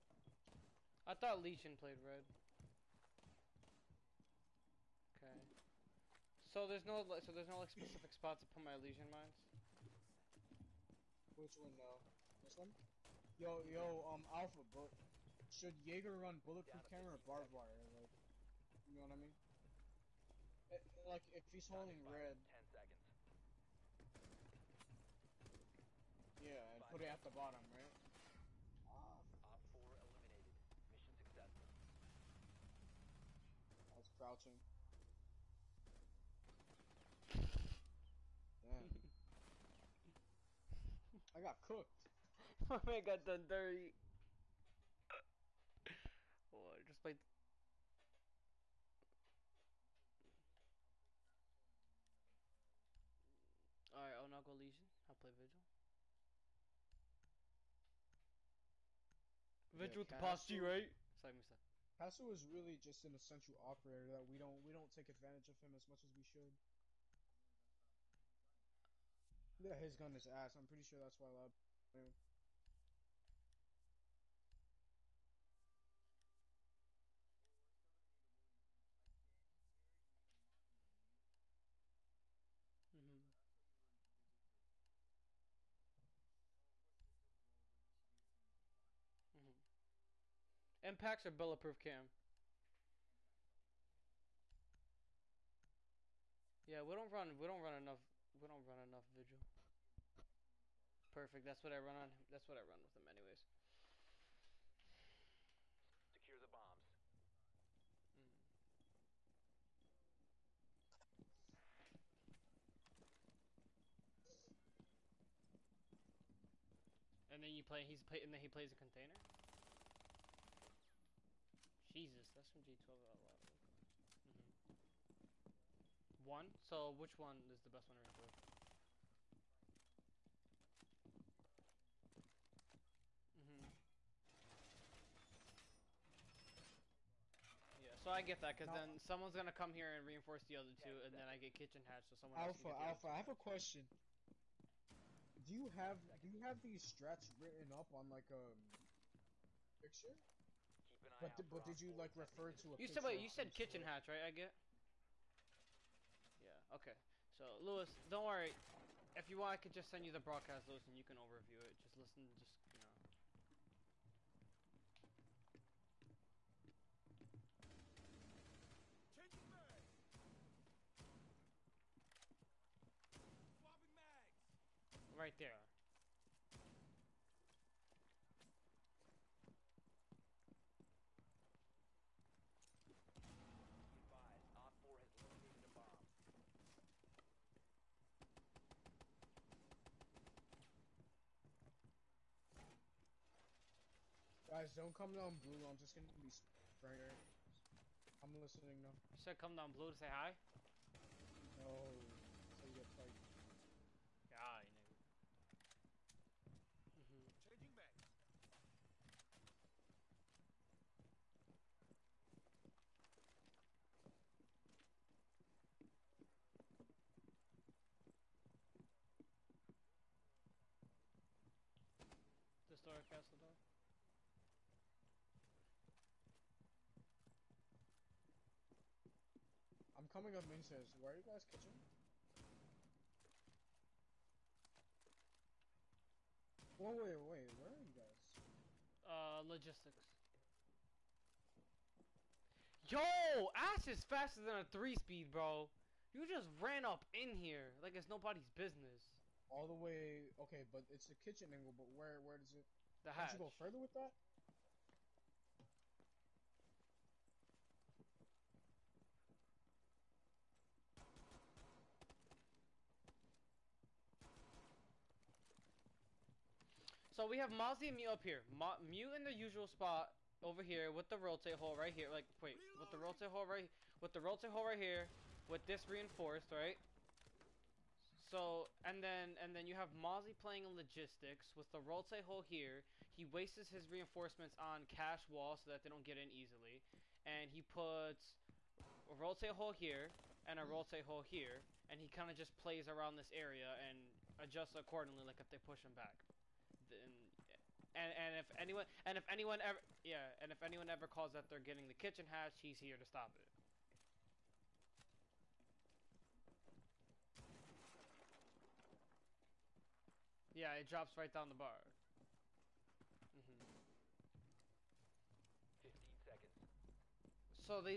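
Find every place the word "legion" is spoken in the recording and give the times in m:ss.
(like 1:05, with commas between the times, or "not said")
0:01, 0:08, 0:54.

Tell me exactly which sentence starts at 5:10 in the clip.
Yeah, it drops right down the bar.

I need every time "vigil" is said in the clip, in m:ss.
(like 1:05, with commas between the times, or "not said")
0:55, 0:59, 1:39.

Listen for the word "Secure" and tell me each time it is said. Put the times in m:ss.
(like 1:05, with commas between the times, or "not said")
1:46.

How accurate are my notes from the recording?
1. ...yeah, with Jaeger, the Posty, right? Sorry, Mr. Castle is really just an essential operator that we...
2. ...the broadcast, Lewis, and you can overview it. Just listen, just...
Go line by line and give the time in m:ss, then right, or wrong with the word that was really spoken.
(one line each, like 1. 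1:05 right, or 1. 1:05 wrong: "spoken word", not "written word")
1. 0:59 wrong: "Castle", not "Jaeger"
2. 2:40 right.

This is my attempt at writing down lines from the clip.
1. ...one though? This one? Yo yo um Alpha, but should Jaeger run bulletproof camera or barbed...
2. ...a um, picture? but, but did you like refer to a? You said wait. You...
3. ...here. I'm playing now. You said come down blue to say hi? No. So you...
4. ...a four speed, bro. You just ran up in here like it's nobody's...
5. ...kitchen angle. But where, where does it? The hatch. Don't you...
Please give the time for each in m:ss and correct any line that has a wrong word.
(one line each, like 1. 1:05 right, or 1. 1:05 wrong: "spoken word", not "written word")
1. 0:11 right
2. 2:28 right
3. 3:16 wrong: "listening", not "playing"
4. 4:04 wrong: "three", not "four"
5. 4:11 right.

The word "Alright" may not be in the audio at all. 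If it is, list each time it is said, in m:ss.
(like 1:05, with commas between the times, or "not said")
0:53.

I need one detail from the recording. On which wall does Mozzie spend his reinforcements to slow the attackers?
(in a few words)
Cash wall.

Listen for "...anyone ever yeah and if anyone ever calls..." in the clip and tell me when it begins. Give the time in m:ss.
4:59.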